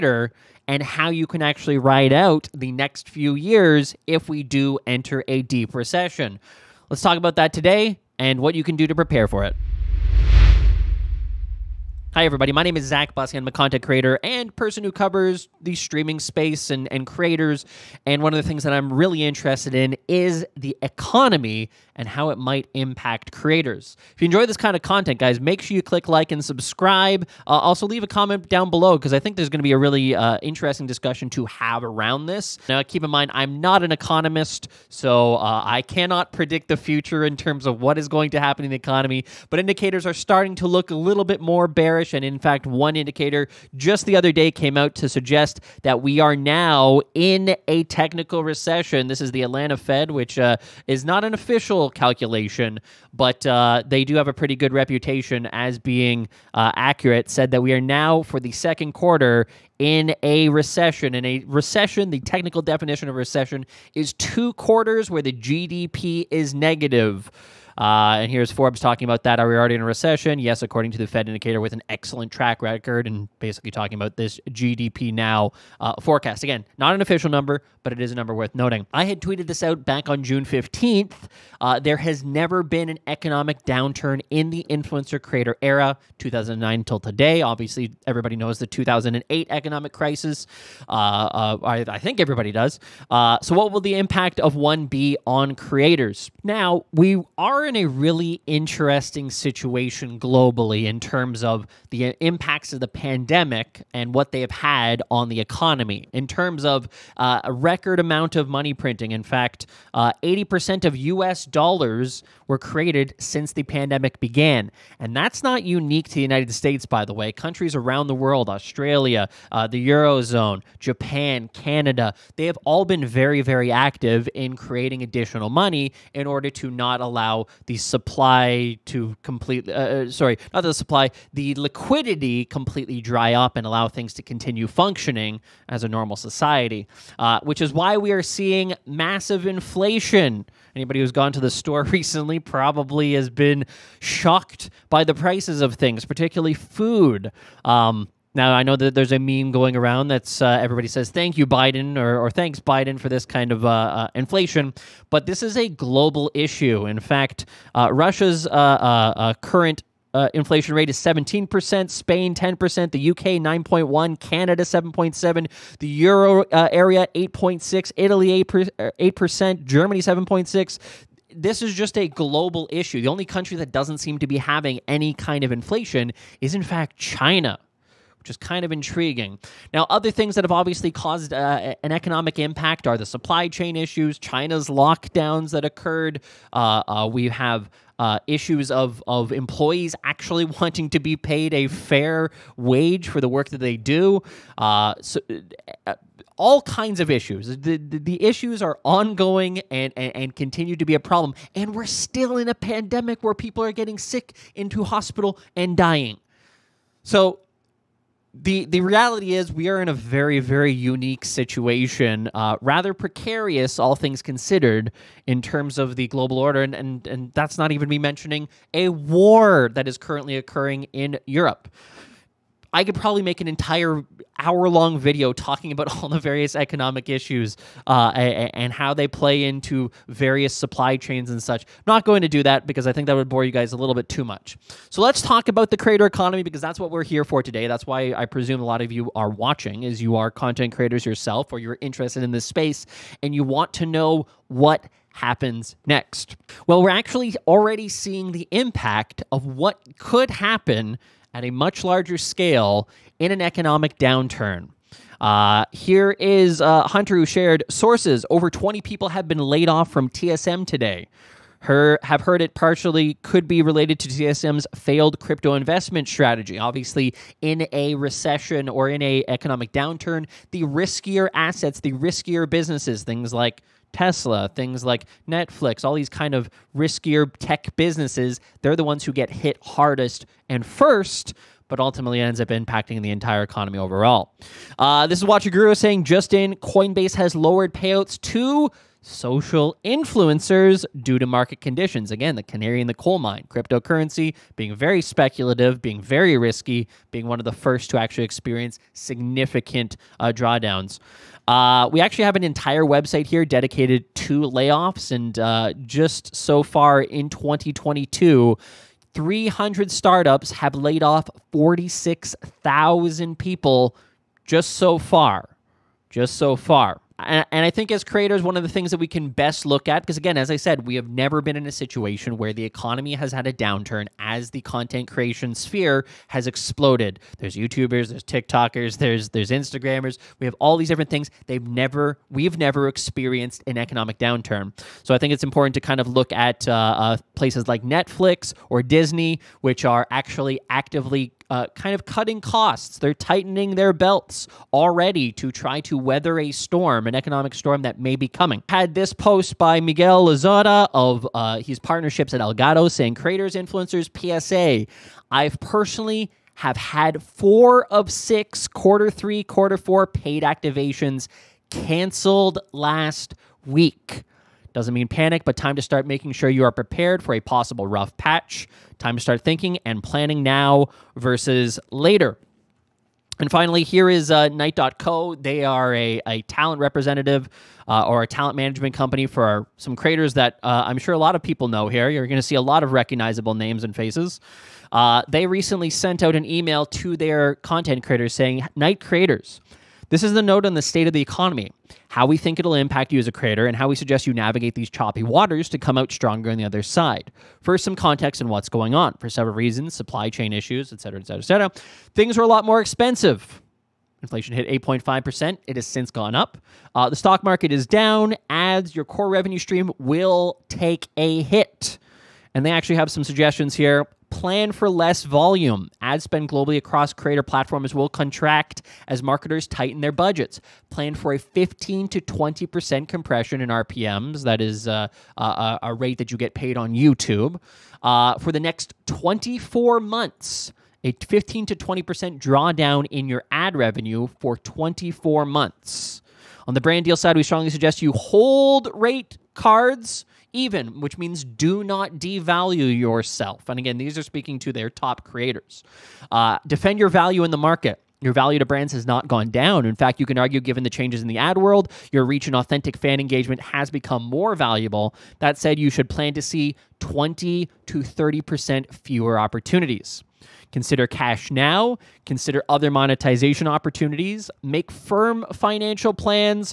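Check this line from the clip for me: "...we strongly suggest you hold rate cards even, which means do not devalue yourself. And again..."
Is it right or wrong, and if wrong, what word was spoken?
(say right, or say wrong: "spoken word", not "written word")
right.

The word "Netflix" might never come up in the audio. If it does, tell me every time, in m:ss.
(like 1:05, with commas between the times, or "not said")
4:35, 5:37.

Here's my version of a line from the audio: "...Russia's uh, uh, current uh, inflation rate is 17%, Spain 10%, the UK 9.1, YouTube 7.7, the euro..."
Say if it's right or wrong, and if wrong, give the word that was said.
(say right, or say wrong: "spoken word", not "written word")
wrong: "Canada", not "YouTube".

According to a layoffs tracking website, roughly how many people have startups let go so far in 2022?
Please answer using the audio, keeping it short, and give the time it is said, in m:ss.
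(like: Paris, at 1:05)
46,000, at 5:11.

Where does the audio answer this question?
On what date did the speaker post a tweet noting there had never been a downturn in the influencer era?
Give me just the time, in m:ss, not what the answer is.
1:20.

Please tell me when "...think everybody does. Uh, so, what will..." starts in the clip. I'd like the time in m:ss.
1:31.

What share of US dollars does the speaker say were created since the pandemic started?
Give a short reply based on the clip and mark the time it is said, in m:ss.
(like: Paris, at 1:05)
80%, at 1:50.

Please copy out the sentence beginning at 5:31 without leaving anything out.
They've never we've never experienced an economic downturn.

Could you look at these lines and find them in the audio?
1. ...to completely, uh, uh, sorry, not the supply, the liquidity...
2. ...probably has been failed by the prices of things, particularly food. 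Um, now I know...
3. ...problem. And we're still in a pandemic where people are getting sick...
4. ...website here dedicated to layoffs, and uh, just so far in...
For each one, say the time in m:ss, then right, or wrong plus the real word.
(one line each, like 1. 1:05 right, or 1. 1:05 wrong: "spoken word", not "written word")
1. 2:08 right
2. 2:22 wrong: "shocked", not "failed"
3. 3:20 right
4. 5:02 right.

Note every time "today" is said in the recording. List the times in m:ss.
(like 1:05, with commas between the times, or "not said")
0:07, 1:26, 3:57, 4:20.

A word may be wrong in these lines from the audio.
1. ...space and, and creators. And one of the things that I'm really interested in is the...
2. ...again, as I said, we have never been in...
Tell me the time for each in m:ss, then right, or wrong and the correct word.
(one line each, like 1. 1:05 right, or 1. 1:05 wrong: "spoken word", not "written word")
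1. 0:16 right
2. 5:20 right.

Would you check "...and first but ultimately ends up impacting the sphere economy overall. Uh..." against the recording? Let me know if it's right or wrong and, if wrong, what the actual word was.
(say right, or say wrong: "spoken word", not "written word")
wrong: "entire", not "sphere".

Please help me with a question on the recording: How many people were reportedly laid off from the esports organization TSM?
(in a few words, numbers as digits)
Over 20.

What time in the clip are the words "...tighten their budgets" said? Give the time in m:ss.
6:59.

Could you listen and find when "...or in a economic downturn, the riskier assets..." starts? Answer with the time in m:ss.
4:28.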